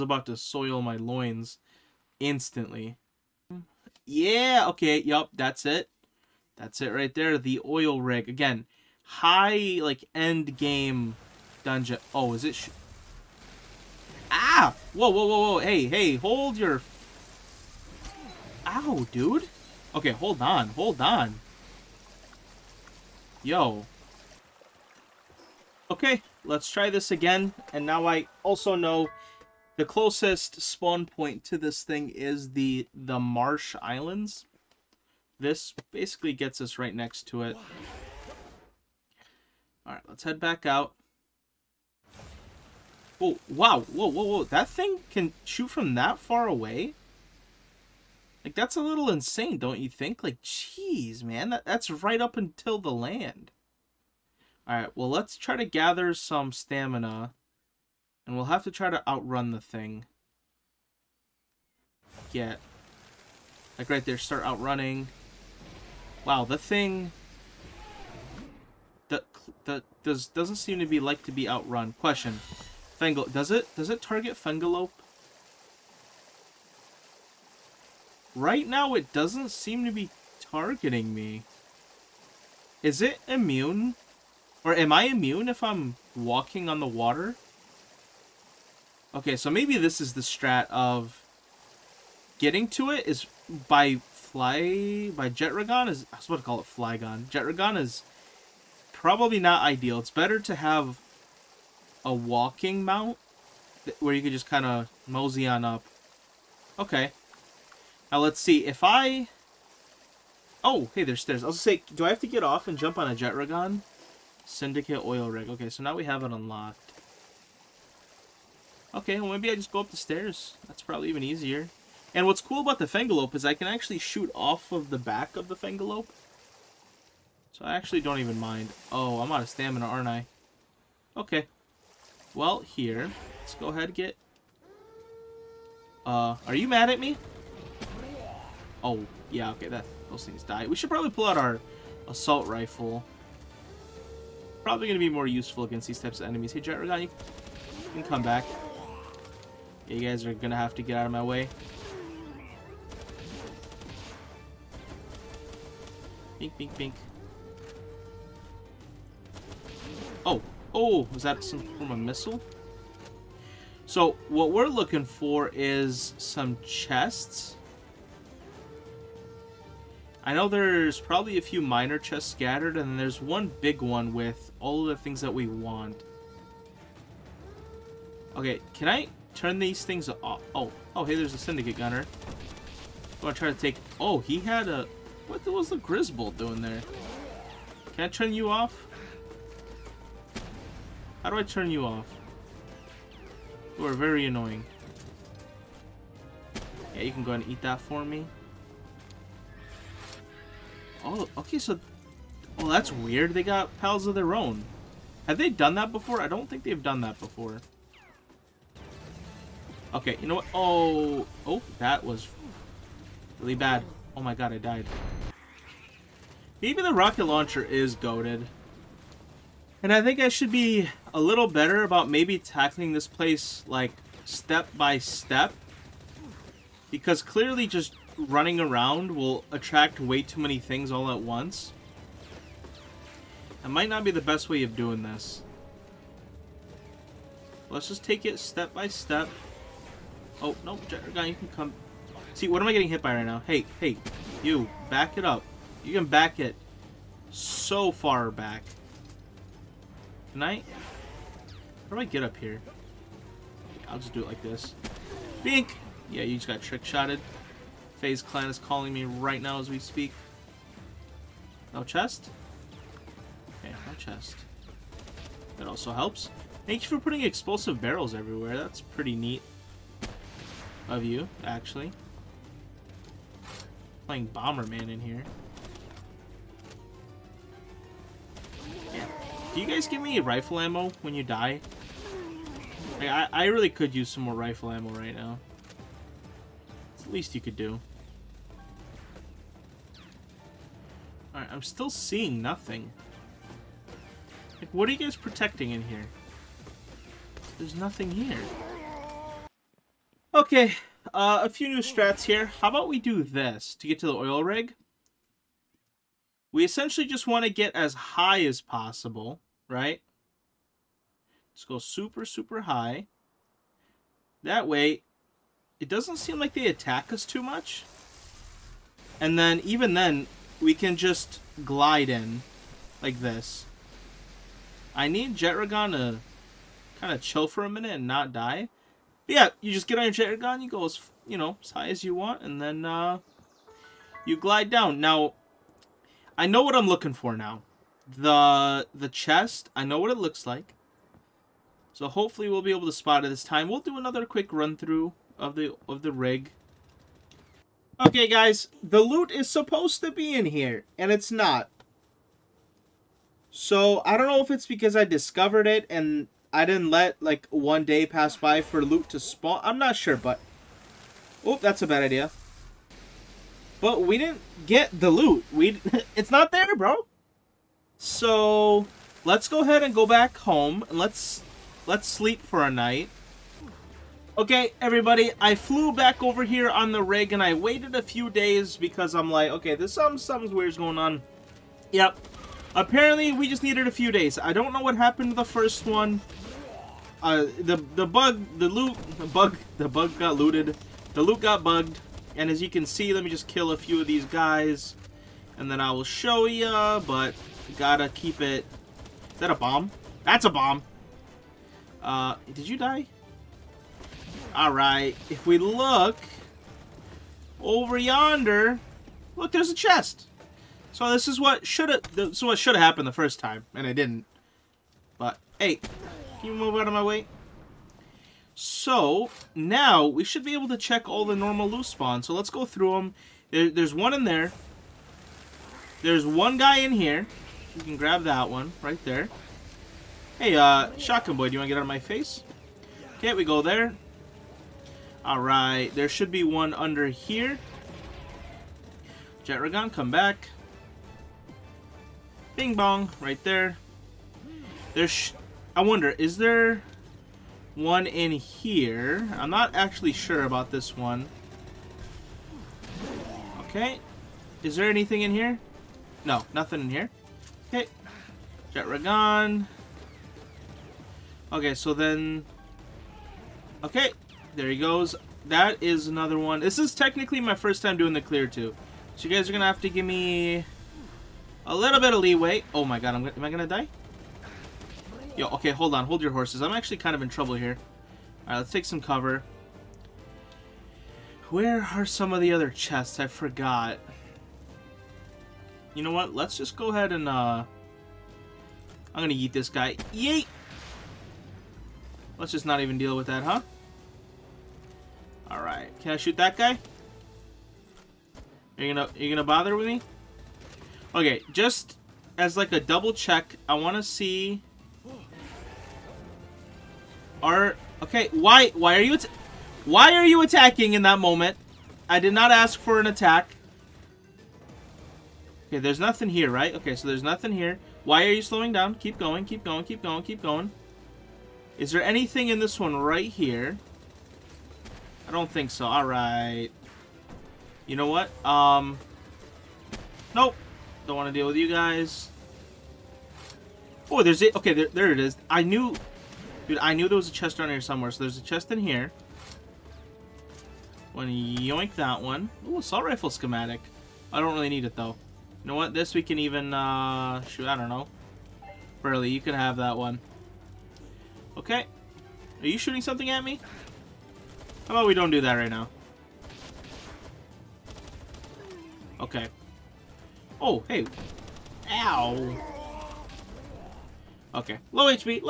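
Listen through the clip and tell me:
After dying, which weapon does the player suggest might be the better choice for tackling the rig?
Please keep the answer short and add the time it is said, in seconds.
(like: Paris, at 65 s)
rocket launcher, at 216 s.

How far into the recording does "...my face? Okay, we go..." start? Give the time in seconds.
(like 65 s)
431 s.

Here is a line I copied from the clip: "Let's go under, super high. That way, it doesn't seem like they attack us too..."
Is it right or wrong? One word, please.
wrong.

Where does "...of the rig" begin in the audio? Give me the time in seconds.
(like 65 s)
345 s.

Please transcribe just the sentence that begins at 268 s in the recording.
That's pretty neat of you, actually.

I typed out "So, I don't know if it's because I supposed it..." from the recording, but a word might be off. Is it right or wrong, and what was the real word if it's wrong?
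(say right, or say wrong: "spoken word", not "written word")
wrong: "discovered", not "supposed".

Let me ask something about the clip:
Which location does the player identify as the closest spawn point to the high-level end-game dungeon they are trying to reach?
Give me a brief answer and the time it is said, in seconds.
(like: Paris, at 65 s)
Marsh Islands, at 33 s.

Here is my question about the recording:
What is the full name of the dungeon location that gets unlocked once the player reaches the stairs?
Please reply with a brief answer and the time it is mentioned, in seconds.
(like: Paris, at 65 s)
Syndicate oil rig, at 114 s.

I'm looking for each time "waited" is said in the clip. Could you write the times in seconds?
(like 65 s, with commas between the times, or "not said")
377 s.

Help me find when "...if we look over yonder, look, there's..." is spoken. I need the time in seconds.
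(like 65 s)
405 s.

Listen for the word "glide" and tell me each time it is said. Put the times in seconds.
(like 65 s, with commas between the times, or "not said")
321 s, 334 s.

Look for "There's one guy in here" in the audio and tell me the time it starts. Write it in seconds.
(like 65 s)
426 s.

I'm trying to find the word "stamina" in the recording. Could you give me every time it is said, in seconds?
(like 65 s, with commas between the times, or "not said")
56 s, 129 s.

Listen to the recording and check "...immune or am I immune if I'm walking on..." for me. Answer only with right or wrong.
right.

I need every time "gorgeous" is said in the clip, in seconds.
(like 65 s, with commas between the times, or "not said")
not said.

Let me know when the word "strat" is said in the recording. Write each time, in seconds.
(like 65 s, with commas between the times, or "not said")
90 s, 301 s.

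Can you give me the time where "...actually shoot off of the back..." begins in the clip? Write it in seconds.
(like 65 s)
123 s.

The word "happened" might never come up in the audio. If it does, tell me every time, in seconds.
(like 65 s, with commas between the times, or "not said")
384 s, 412 s.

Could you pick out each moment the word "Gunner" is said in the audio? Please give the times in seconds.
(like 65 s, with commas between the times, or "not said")
181 s.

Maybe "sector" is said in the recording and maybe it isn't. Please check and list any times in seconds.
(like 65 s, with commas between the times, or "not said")
not said.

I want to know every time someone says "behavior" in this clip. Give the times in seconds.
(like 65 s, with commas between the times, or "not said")
not said.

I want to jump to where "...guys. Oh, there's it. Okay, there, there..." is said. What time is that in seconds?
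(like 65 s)
531 s.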